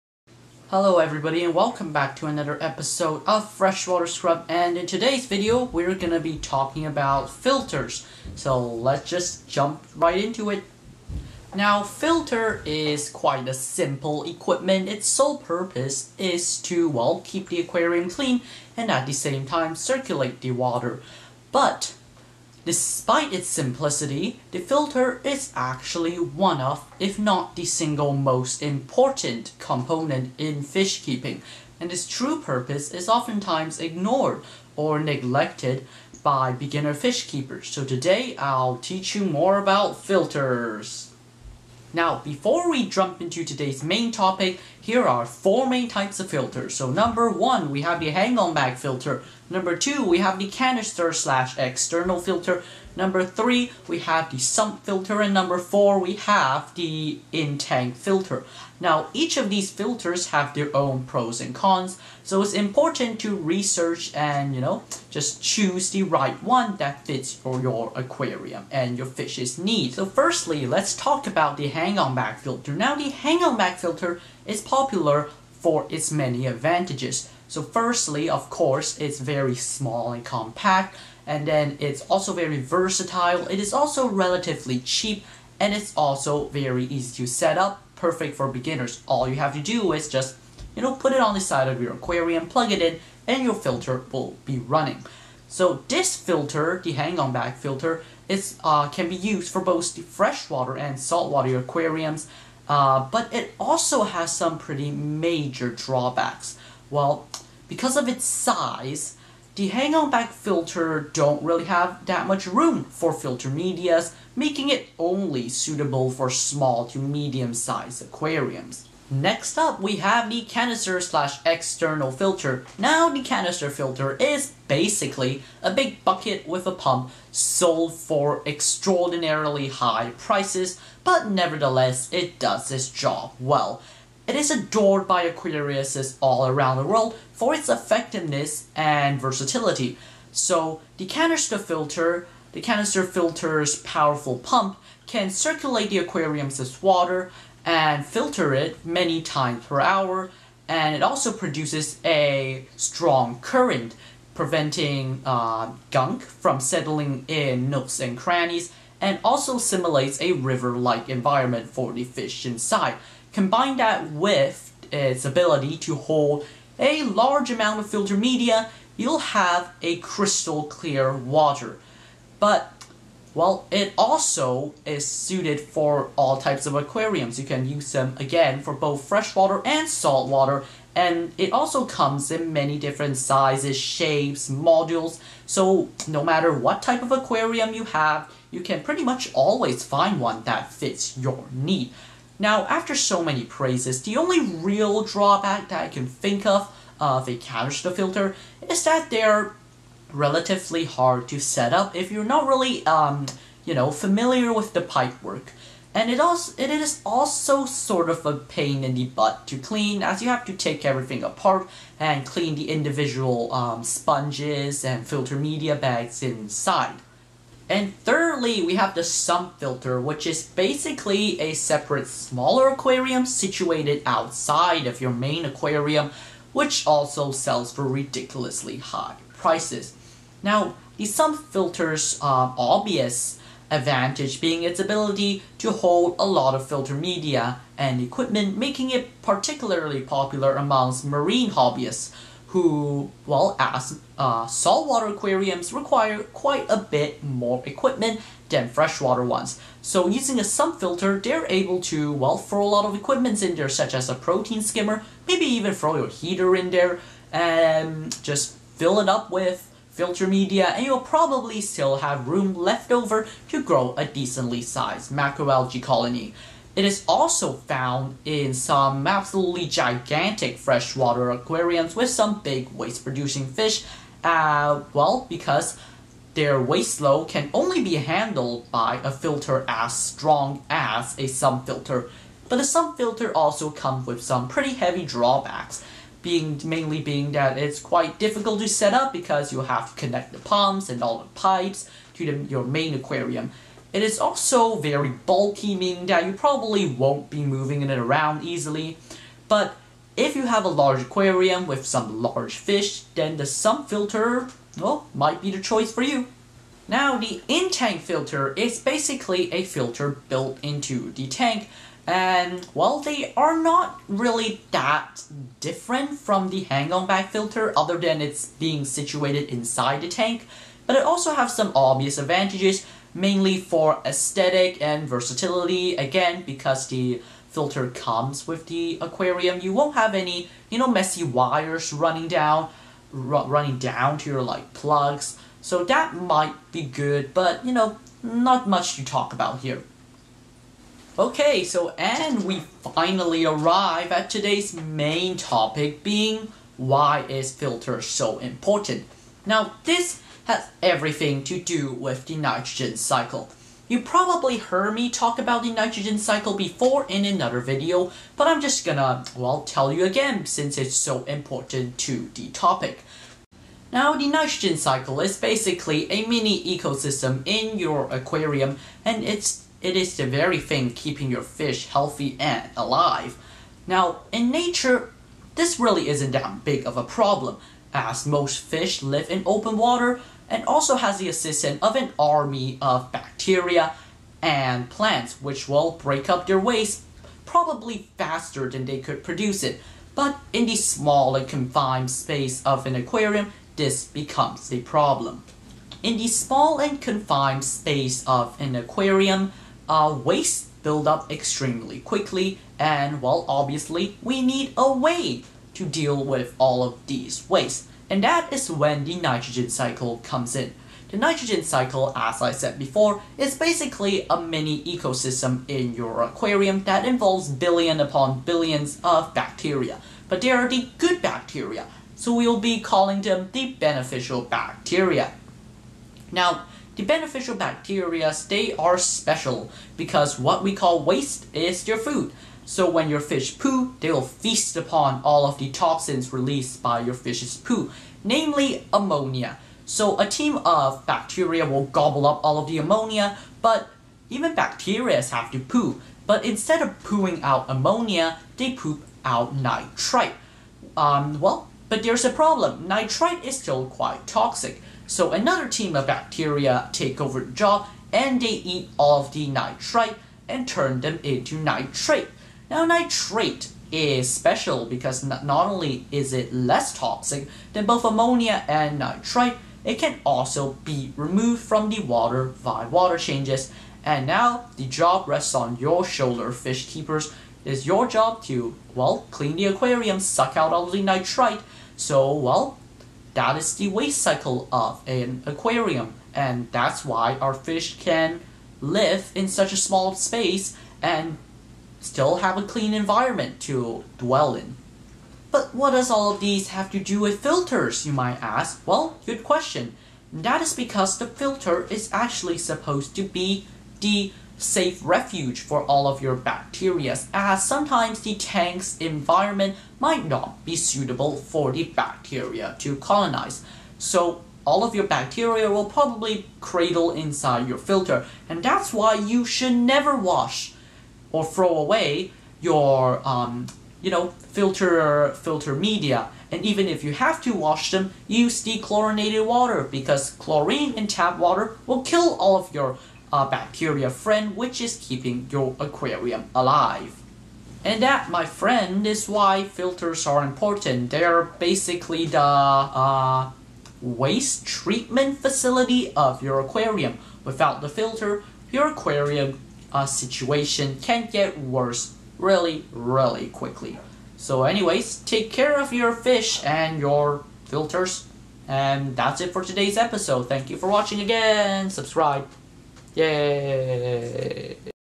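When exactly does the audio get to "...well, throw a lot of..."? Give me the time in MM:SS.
04:12.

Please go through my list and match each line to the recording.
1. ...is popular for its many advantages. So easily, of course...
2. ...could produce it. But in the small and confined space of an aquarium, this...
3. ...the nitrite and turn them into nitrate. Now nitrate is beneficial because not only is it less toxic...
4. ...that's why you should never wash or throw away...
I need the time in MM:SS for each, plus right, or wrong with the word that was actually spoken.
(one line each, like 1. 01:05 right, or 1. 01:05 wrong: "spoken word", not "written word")
1. 01:14 wrong: "firstly", not "easily"
2. 06:28 right
3. 07:39 wrong: "special", not "beneficial"
4. 08:38 right.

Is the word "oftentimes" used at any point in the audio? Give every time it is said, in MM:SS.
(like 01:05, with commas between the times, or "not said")
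00:33.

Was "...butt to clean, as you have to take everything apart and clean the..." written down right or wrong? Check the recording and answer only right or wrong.
right.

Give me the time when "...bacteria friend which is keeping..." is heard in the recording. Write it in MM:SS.
08:53.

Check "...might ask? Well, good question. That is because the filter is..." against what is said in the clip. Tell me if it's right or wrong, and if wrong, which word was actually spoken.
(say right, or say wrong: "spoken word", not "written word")
right.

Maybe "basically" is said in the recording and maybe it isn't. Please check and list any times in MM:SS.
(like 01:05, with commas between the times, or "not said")
02:04, 03:40, 05:08, 06:05, 06:53, 09:01.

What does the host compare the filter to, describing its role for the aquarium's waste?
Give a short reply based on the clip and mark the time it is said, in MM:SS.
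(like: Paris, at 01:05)
waste treatment facility, at 09:04.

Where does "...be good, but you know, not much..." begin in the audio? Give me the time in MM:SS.
05:36.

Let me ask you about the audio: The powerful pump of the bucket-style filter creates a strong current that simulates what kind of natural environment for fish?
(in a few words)
river-like environment.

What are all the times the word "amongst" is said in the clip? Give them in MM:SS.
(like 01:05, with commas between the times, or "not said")
04:00.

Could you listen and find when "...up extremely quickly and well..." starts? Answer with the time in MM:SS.
06:41.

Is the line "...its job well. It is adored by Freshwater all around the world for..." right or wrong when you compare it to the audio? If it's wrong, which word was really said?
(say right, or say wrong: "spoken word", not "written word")
wrong: "Aquariuses", not "Freshwater".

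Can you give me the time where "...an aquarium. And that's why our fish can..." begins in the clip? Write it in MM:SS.
08:05.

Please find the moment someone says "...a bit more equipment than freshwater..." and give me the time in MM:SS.
04:06.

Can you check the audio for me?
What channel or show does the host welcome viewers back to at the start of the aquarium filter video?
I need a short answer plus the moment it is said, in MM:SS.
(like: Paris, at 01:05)
Freshwater Scrub, at 00:03.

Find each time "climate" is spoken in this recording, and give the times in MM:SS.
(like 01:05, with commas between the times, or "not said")
not said.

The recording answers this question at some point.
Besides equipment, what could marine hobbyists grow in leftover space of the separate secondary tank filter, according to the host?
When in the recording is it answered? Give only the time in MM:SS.
04:25.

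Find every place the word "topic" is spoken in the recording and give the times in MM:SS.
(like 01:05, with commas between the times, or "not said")
00:44, 05:45, 06:02.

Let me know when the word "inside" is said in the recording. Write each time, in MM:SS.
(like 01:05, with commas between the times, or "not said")
02:42, 03:36, 05:19, 08:37.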